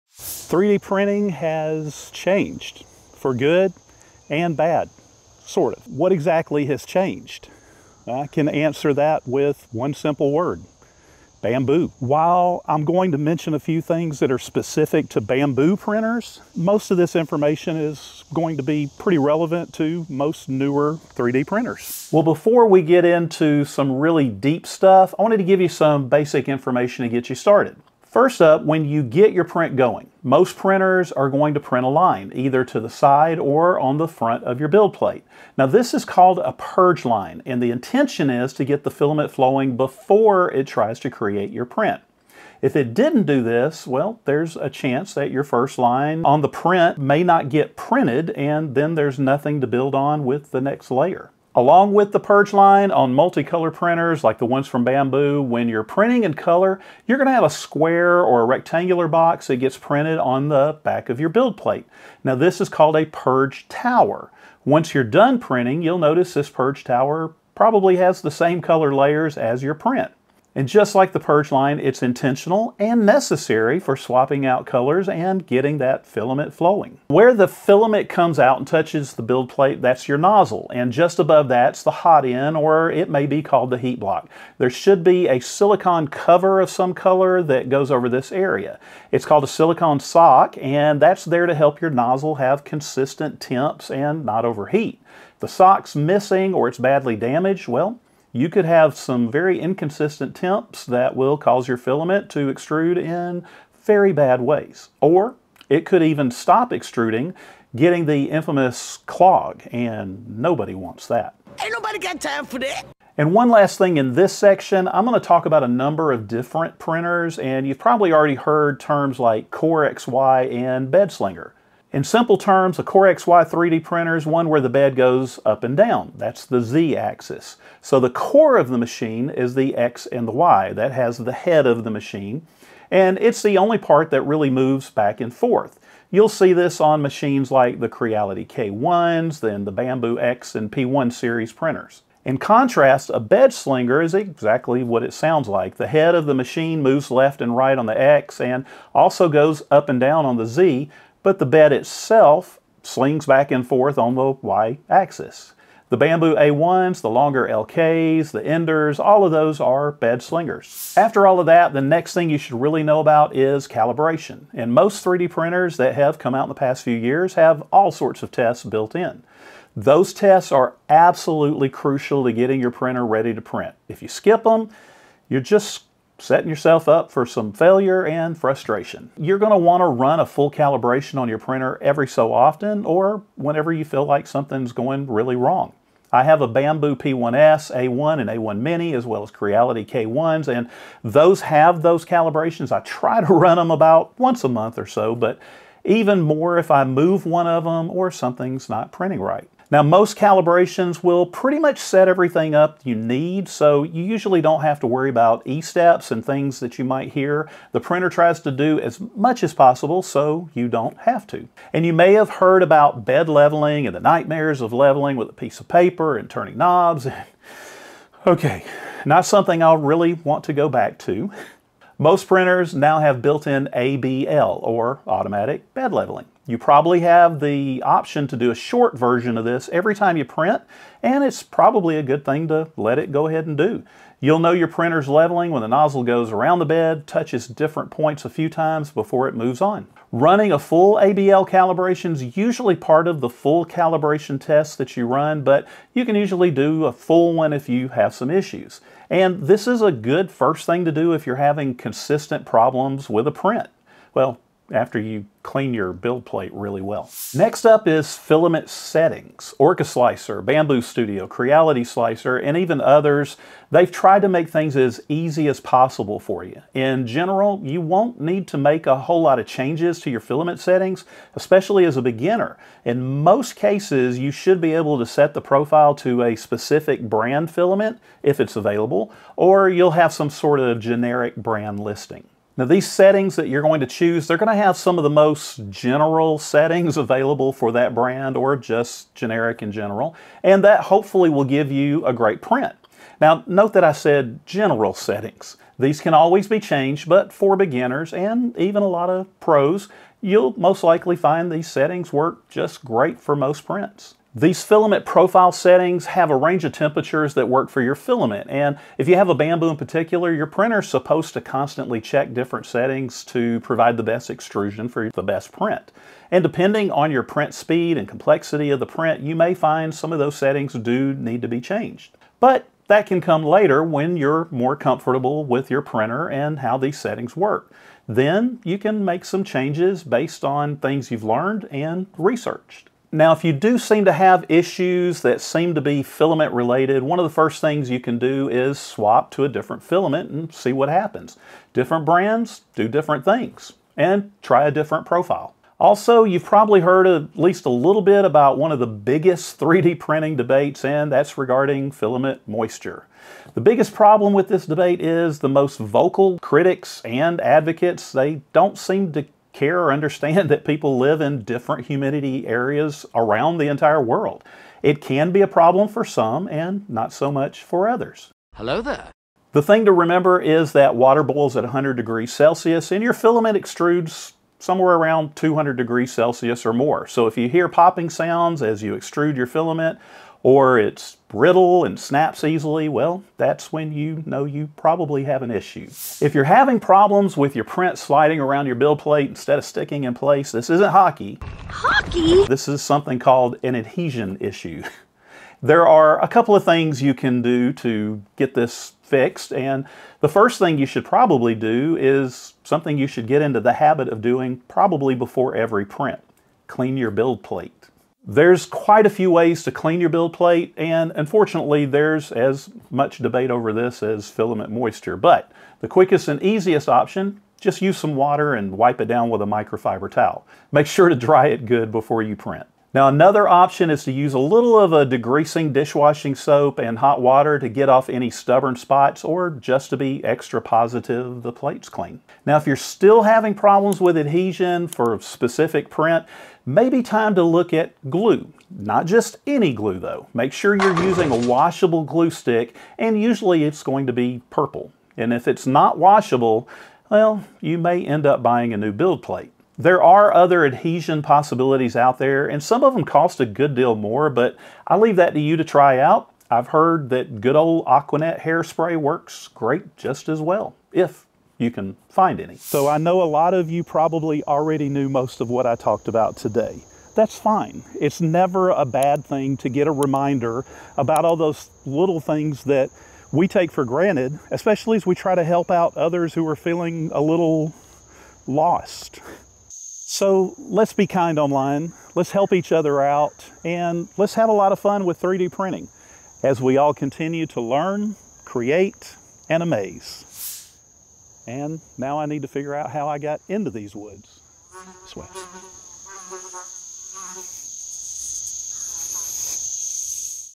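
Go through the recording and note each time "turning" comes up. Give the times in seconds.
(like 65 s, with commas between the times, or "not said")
216 s.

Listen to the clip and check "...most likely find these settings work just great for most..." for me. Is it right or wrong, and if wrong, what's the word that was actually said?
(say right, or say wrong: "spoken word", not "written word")
right.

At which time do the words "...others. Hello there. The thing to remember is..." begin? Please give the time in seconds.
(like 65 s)
367 s.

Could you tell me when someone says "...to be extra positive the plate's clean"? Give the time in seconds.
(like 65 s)
429 s.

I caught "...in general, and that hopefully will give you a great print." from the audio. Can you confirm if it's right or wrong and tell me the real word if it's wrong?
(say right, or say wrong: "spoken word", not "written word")
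right.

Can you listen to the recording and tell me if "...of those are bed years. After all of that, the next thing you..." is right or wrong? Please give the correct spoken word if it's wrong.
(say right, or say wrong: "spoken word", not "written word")
wrong: "slingers", not "years".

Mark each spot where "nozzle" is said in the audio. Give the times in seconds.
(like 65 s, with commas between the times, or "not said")
80 s, 91 s, 235 s.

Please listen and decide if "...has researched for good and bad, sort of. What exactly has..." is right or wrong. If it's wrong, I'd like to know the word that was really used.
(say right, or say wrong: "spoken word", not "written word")
wrong: "changed", not "researched".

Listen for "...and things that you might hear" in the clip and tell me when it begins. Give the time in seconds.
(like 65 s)
206 s.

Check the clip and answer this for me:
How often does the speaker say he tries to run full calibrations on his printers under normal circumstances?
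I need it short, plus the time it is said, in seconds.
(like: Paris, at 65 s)
About once a month, at 193 s.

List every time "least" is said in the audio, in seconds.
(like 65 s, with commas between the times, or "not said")
347 s.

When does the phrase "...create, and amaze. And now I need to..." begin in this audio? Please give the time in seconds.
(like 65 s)
488 s.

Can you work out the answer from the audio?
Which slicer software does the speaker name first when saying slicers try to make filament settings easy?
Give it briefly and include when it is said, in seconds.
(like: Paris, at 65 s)
Orca Slicer, at 259 s.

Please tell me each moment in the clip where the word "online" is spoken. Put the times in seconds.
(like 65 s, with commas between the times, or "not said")
481 s.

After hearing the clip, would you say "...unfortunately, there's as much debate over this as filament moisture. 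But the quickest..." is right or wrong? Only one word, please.
right.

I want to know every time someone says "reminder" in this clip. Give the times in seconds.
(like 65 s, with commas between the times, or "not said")
469 s.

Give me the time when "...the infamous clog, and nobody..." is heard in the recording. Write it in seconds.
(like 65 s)
108 s.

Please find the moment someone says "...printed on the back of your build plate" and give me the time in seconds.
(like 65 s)
59 s.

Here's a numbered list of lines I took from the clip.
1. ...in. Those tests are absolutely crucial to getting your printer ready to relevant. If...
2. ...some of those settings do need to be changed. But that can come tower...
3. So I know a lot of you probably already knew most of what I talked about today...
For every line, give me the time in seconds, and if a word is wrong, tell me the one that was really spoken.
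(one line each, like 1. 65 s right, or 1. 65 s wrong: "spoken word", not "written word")
1. 168 s wrong: "print", not "relevant"
2. 319 s wrong: "later", not "tower"
3. 462 s right.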